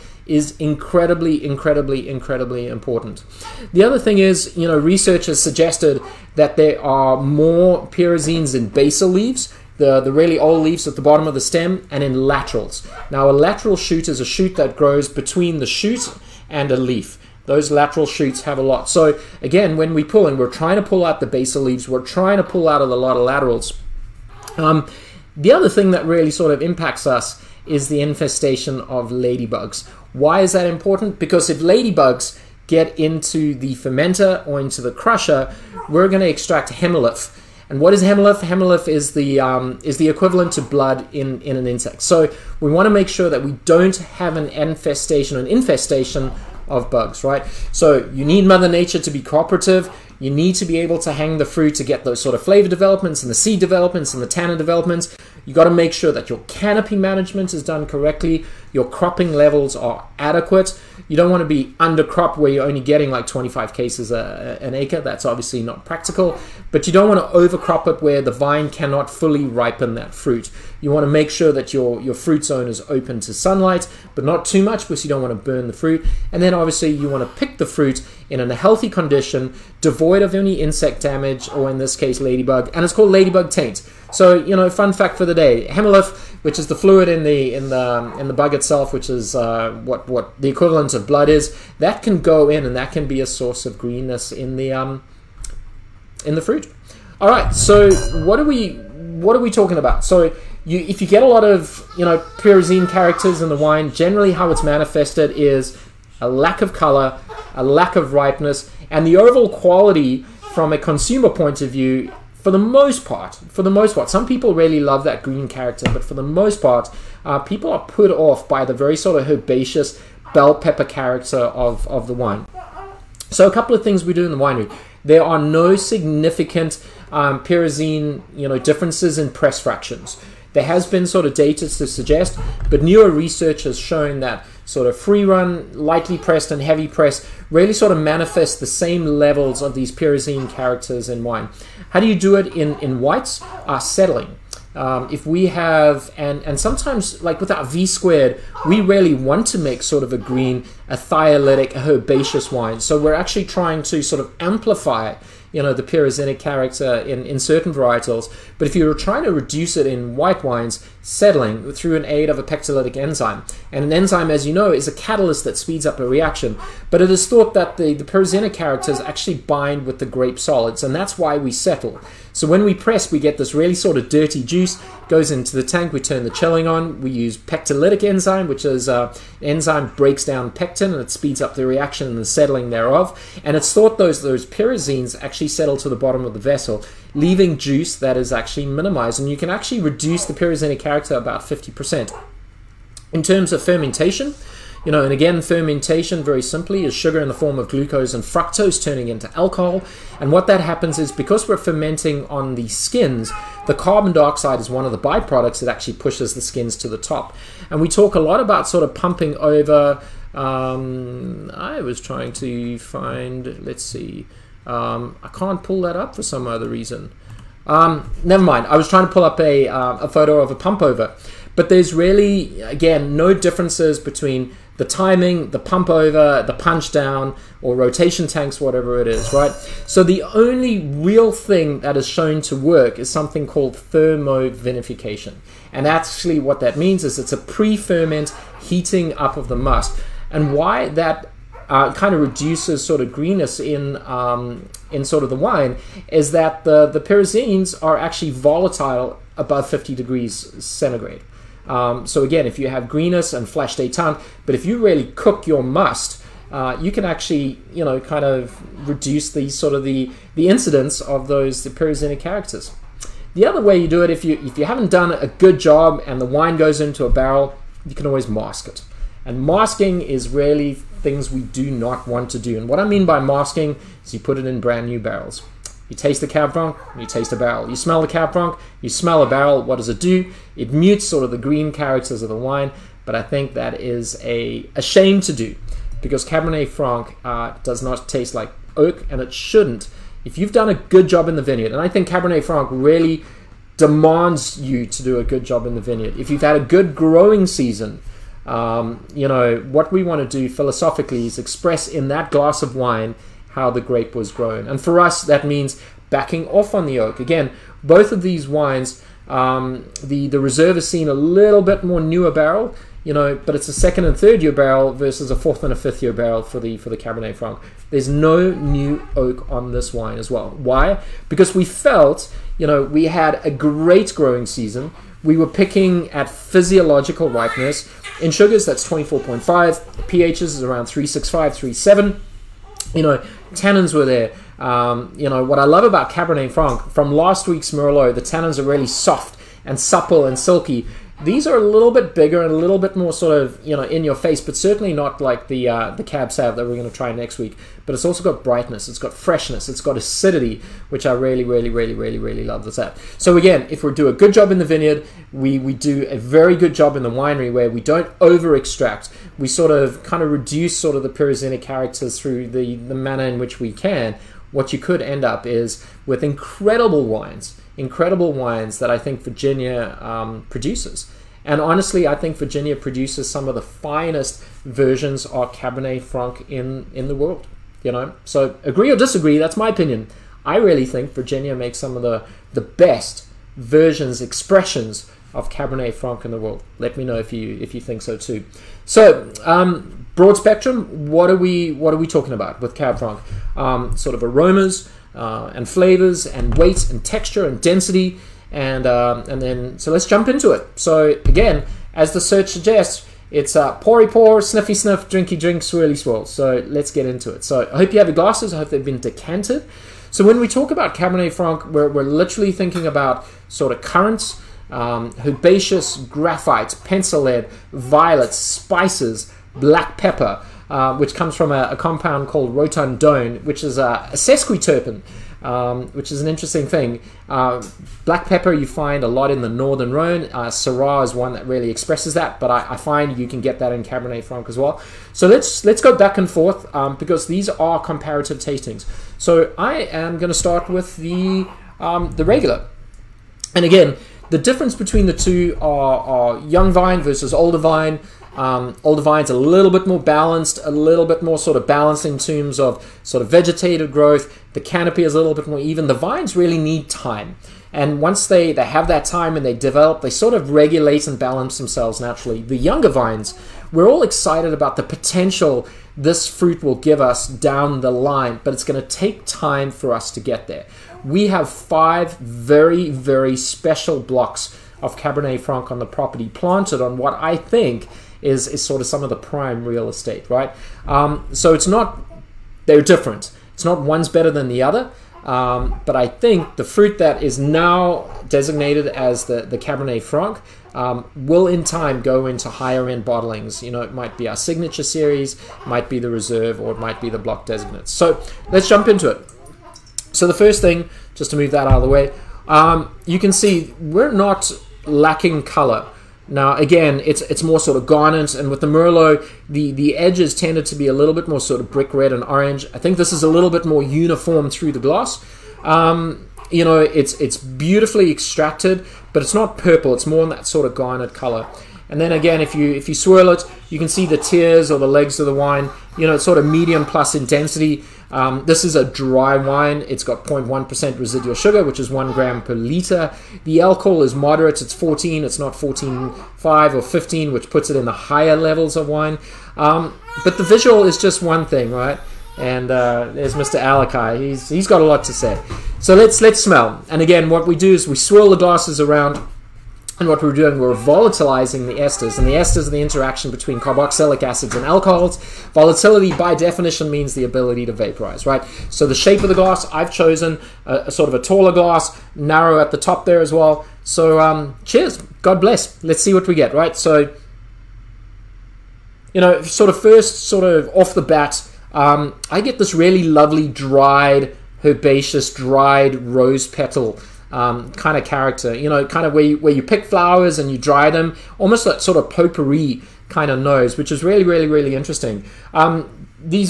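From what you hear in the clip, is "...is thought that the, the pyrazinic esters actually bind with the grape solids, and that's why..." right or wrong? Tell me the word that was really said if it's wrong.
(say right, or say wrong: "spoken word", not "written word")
wrong: "characters", not "esters".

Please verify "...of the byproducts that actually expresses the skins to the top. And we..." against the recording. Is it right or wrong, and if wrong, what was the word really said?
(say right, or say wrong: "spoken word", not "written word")
wrong: "pushes", not "expresses".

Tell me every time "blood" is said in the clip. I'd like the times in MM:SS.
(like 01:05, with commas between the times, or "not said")
00:40, 01:31.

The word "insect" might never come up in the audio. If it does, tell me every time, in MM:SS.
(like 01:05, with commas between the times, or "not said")
00:41, 01:20.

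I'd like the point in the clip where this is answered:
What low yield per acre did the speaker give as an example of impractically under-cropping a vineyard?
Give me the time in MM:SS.
01:03.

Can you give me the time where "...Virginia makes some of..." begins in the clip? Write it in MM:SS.
06:21.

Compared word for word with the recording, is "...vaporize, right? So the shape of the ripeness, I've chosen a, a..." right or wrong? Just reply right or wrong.
wrong.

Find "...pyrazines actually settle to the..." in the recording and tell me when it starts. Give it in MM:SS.
03:04.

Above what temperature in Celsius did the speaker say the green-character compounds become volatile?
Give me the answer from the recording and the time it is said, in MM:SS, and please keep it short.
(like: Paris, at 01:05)
50 degrees, at 04:09.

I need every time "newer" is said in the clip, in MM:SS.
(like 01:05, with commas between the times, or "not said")
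02:12, 05:12.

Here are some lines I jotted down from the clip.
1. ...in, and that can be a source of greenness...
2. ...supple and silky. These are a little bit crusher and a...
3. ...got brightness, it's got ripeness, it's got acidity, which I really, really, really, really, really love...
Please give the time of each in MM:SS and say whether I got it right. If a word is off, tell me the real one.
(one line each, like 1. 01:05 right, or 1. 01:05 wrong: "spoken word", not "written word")
1. 01:32 right
2. 05:39 wrong: "bigger", not "crusher"
3. 05:48 wrong: "freshness", not "ripeness".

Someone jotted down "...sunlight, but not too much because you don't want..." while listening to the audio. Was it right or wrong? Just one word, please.
right.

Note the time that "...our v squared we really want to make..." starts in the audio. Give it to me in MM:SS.
02:27.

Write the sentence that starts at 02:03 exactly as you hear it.
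So a couple of things we do in the winery.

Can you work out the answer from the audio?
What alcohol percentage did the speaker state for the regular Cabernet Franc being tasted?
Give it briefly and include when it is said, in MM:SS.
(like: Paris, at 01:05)
14, at 08:54.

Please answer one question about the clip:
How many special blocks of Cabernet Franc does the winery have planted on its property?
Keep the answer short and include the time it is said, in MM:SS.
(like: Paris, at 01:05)
Five, at 07:51.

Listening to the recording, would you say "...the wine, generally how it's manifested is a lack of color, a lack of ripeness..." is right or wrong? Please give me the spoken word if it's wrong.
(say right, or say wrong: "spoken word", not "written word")
right.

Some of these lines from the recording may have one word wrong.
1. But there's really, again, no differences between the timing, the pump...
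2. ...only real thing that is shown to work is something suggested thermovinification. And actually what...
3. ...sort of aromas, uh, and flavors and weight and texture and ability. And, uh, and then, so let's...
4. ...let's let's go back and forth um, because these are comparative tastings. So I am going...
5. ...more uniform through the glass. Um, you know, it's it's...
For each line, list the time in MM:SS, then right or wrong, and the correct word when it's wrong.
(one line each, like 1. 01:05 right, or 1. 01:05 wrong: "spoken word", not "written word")
1. 03:41 right
2. 03:50 wrong: "called", not "suggested"
3. 06:33 wrong: "density", not "ability"
4. 07:15 right
5. 08:33 right.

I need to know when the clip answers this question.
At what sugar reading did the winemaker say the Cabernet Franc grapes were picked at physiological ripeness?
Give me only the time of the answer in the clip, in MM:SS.
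05:28.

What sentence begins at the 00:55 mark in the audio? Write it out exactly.
You got to make sure that your canopy management is done correctly, your cropping levels are adequate.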